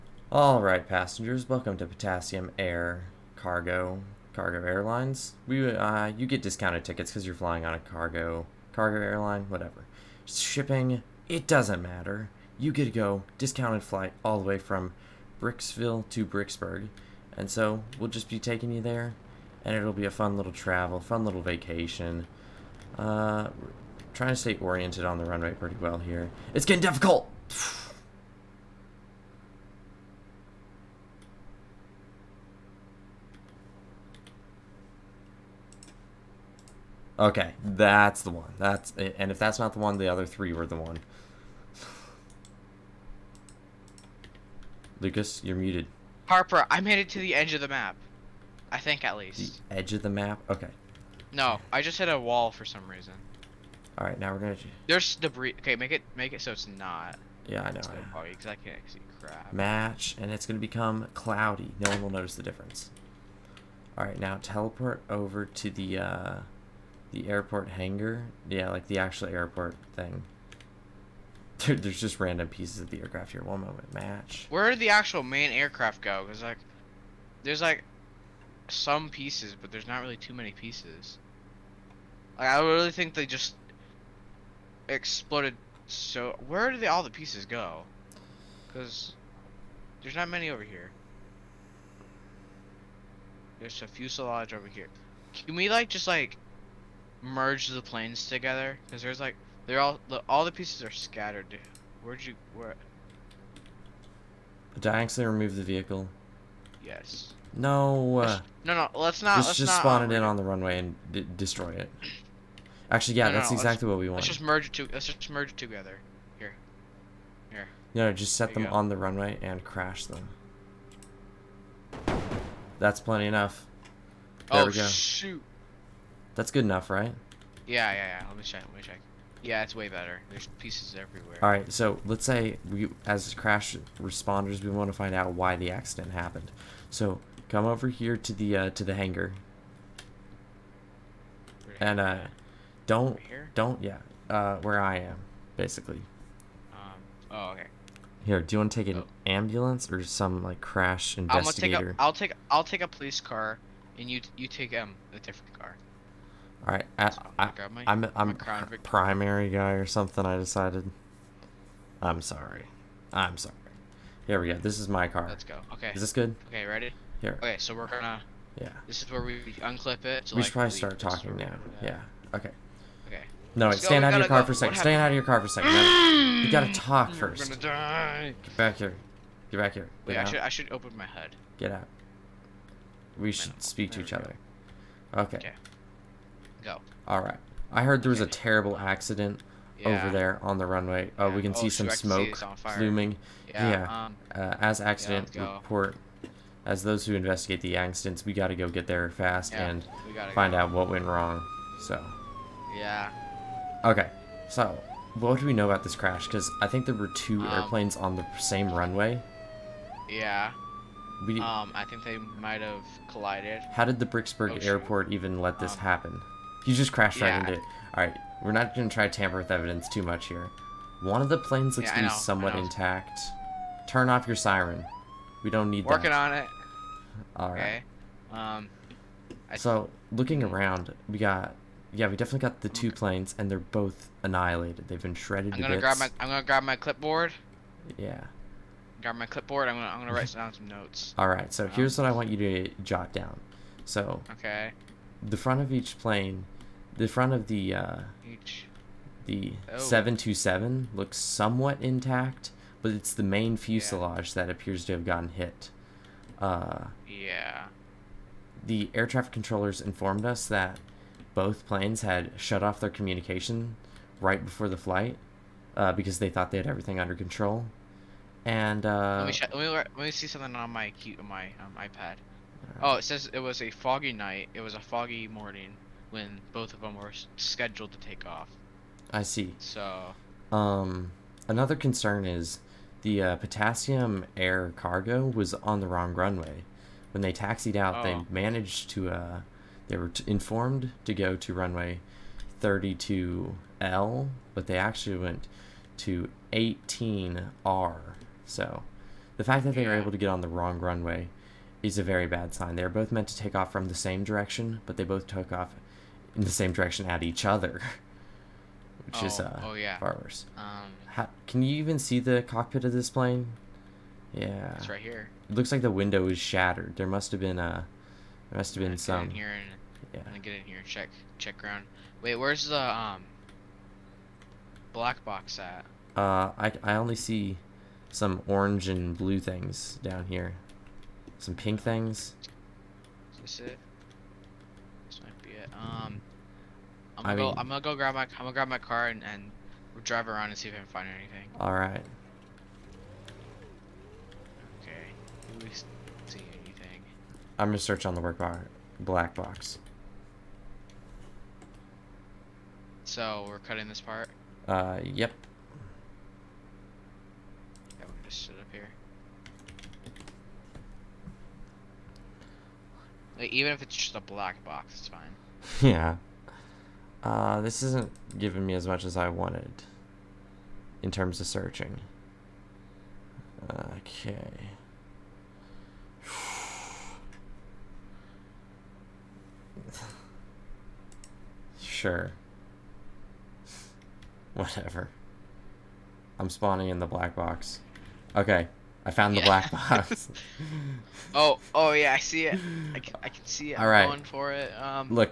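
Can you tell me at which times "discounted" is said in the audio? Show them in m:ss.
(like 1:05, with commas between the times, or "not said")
0:06, 0:13.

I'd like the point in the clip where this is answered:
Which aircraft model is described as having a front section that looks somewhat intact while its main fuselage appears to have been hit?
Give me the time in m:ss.
4:09.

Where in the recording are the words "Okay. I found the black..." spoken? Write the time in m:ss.
6:28.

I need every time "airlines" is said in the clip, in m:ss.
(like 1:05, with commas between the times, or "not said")
0:04, 0:09.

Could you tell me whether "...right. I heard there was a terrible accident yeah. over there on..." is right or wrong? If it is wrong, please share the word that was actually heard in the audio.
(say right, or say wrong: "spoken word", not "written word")
right.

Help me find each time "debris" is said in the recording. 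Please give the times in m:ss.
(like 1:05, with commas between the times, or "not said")
0:55.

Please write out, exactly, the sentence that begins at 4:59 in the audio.
were able to get on the wrong runway is a very bad sign.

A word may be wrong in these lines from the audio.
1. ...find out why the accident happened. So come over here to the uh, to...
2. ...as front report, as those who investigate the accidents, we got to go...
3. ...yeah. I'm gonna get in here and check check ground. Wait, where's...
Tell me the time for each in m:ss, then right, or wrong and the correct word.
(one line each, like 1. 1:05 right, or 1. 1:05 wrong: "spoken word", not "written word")
1. 2:14 right
2. 3:14 wrong: "accident", not "front"
3. 5:20 right.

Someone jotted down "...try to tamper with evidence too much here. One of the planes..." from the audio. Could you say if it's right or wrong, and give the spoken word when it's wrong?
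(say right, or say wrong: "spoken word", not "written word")
right.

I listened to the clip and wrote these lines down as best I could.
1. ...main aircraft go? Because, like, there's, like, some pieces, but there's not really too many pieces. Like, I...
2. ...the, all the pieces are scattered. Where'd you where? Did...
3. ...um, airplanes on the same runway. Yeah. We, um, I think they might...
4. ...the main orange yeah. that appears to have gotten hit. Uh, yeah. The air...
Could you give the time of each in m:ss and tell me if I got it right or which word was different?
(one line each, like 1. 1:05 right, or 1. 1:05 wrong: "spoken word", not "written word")
1. 1:15 right
2. 1:40 right
3. 3:27 right
4. 4:13 wrong: "fuselage", not "orange".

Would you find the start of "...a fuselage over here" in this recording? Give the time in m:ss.
1:33.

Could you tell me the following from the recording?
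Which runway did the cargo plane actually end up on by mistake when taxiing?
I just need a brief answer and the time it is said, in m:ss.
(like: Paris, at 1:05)
18R, at 4:56.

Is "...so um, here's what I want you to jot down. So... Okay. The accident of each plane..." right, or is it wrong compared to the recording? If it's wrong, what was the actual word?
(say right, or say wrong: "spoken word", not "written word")
wrong: "front", not "accident".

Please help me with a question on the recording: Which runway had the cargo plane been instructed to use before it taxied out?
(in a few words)
32L.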